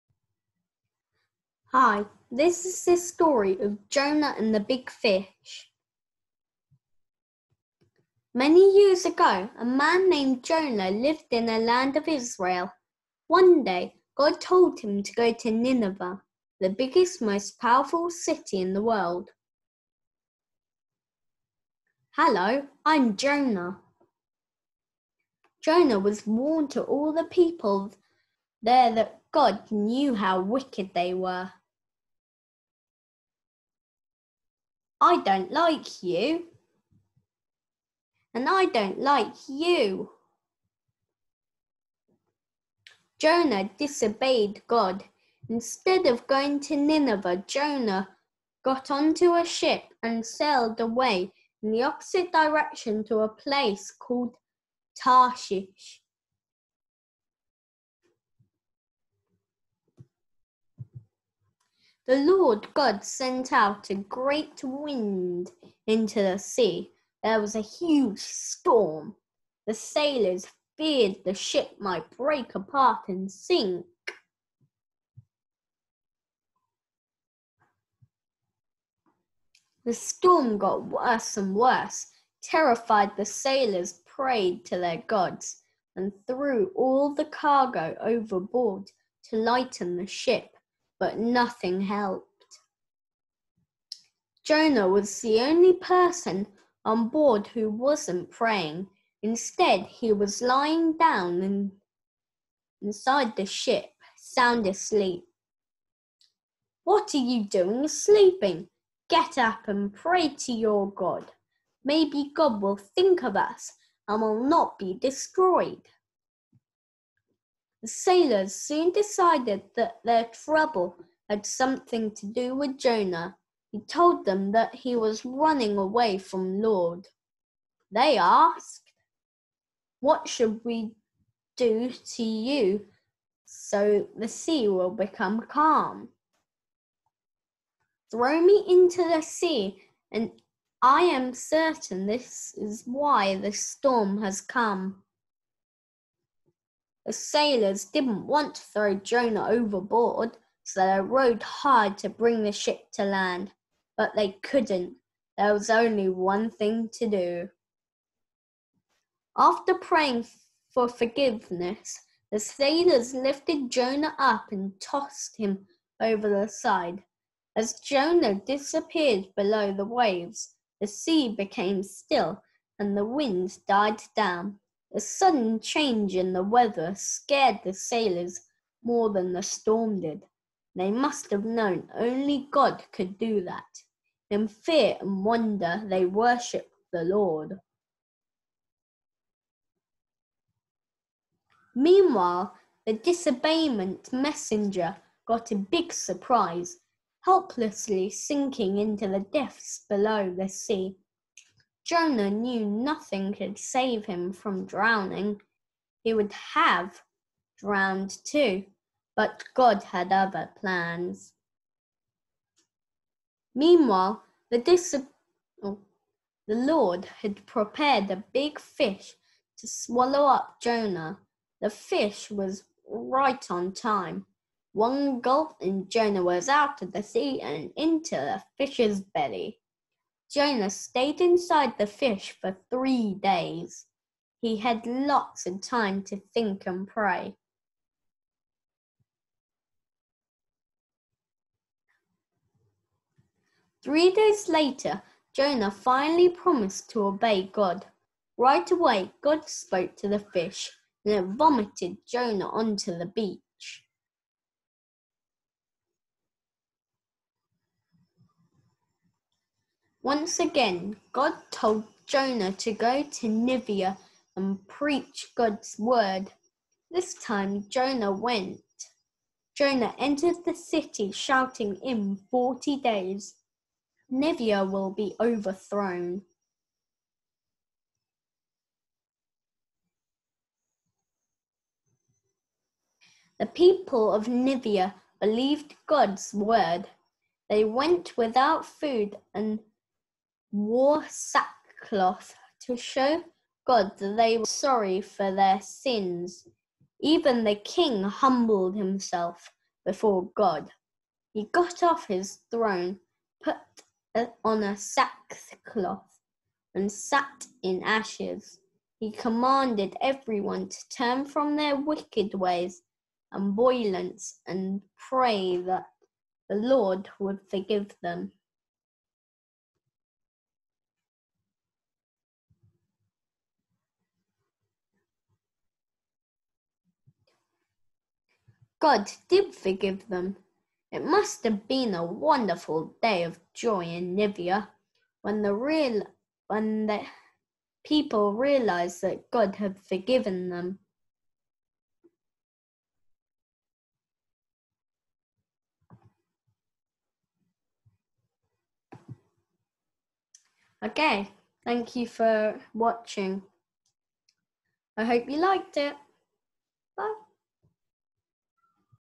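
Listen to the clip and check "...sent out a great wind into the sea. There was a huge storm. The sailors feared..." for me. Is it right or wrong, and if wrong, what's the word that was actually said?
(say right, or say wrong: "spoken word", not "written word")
right.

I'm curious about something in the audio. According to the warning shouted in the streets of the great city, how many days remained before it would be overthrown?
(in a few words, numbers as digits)
40.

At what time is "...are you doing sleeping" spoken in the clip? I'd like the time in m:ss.
1:47.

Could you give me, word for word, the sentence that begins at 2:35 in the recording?
There was only one thing to do.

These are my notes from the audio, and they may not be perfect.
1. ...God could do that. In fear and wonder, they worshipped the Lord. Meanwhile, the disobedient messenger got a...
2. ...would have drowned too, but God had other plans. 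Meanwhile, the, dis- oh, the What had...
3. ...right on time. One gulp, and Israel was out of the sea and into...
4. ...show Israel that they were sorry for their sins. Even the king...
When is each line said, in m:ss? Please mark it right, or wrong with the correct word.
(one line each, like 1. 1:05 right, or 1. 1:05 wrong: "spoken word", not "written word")
1. 3:02 right
2. 3:26 wrong: "Lord", not "What"
3. 3:42 wrong: "Jonah", not "Israel"
4. 4:52 wrong: "God", not "Israel".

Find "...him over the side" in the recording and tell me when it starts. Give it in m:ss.
2:45.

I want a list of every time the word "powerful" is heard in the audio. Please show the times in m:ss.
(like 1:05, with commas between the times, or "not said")
0:17.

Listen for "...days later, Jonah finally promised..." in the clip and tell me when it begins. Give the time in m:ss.
4:04.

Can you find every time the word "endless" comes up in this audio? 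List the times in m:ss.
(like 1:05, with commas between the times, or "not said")
not said.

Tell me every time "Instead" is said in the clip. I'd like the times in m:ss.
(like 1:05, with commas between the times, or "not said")
0:45, 1:39.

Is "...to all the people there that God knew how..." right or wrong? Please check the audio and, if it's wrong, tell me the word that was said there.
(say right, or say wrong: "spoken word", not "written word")
right.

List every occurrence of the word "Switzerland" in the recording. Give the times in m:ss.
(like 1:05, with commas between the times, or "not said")
not said.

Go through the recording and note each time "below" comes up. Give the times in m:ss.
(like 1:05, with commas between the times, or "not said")
2:49, 3:19.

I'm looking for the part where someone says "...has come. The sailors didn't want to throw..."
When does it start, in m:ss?
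2:24.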